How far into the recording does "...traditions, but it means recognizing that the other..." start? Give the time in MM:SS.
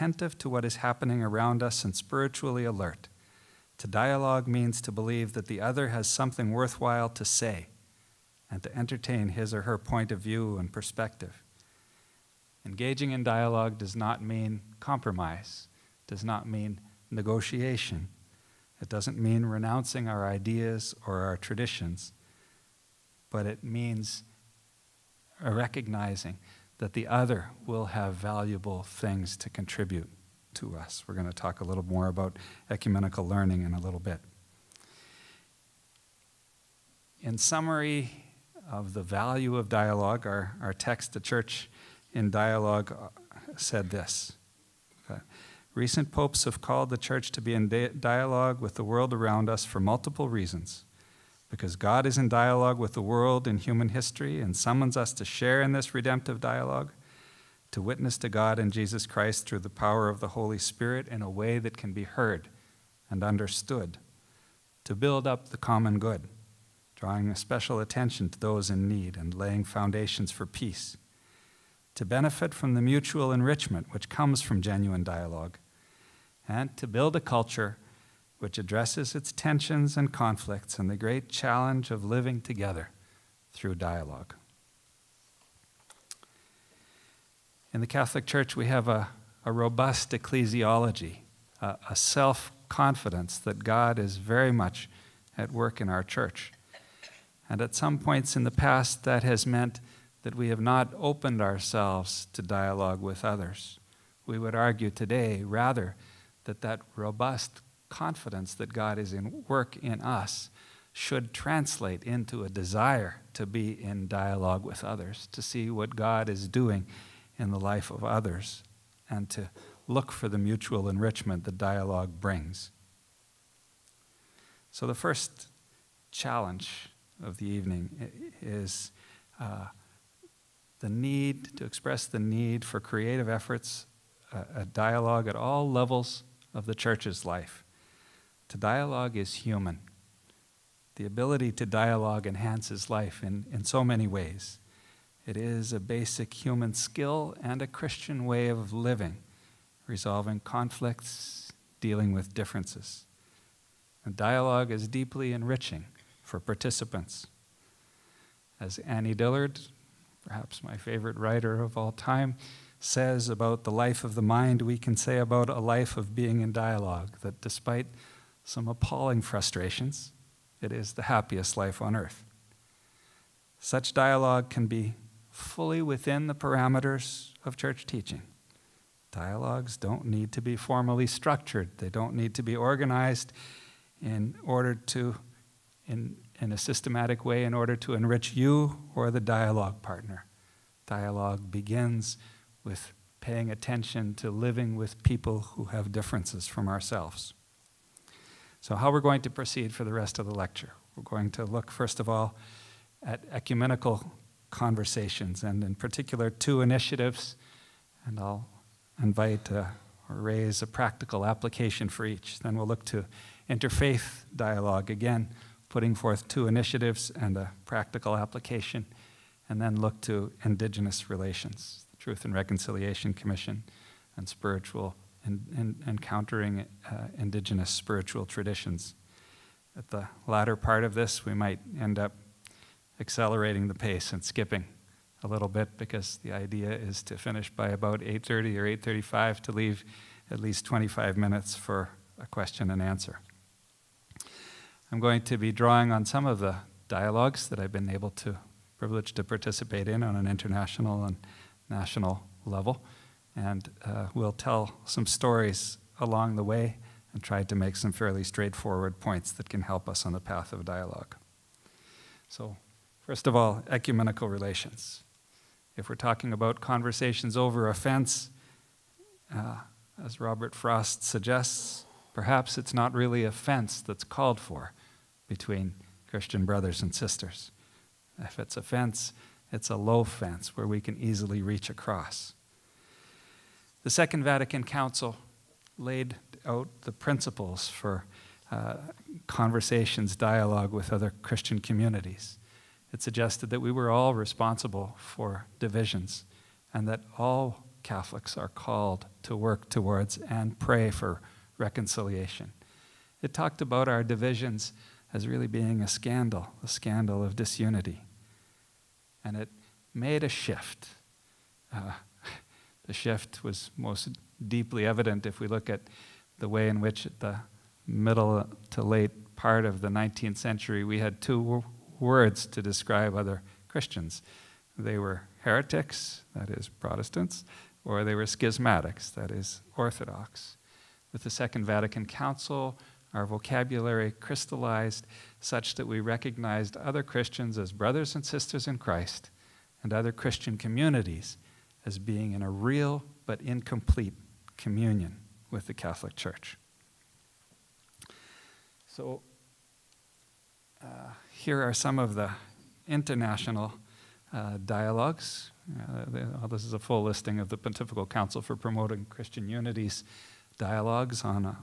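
00:21.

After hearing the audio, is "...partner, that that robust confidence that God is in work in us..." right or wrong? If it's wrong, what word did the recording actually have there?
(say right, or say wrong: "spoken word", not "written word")
wrong: "rather", not "partner".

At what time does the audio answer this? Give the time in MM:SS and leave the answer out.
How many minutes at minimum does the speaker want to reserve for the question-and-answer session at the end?
04:00.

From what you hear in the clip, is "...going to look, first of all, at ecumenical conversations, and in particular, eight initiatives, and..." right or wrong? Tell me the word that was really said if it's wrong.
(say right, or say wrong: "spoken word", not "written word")
wrong: "two", not "eight".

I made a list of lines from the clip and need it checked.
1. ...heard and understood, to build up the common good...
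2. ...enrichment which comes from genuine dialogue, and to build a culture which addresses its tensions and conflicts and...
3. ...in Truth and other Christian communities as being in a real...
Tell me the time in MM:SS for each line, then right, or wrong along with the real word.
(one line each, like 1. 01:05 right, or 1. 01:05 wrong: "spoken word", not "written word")
1. 01:02 right
2. 01:13 right
3. 05:38 wrong: "Christ", not "Truth".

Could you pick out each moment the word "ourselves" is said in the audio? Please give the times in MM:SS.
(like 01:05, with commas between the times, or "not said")
01:41, 03:16.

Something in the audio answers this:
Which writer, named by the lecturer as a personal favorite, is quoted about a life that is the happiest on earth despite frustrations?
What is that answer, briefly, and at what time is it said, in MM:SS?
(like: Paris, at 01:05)
Annie Dillard, at 02:38.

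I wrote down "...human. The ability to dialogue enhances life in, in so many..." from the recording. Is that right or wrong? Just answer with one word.
right.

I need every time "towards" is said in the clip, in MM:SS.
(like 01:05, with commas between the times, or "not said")
04:59.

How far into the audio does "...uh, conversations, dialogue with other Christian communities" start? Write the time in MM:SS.
04:48.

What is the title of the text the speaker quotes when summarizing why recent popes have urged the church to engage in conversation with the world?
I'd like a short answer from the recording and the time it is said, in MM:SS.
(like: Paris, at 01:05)
The Church in Dialogue, at 00:41.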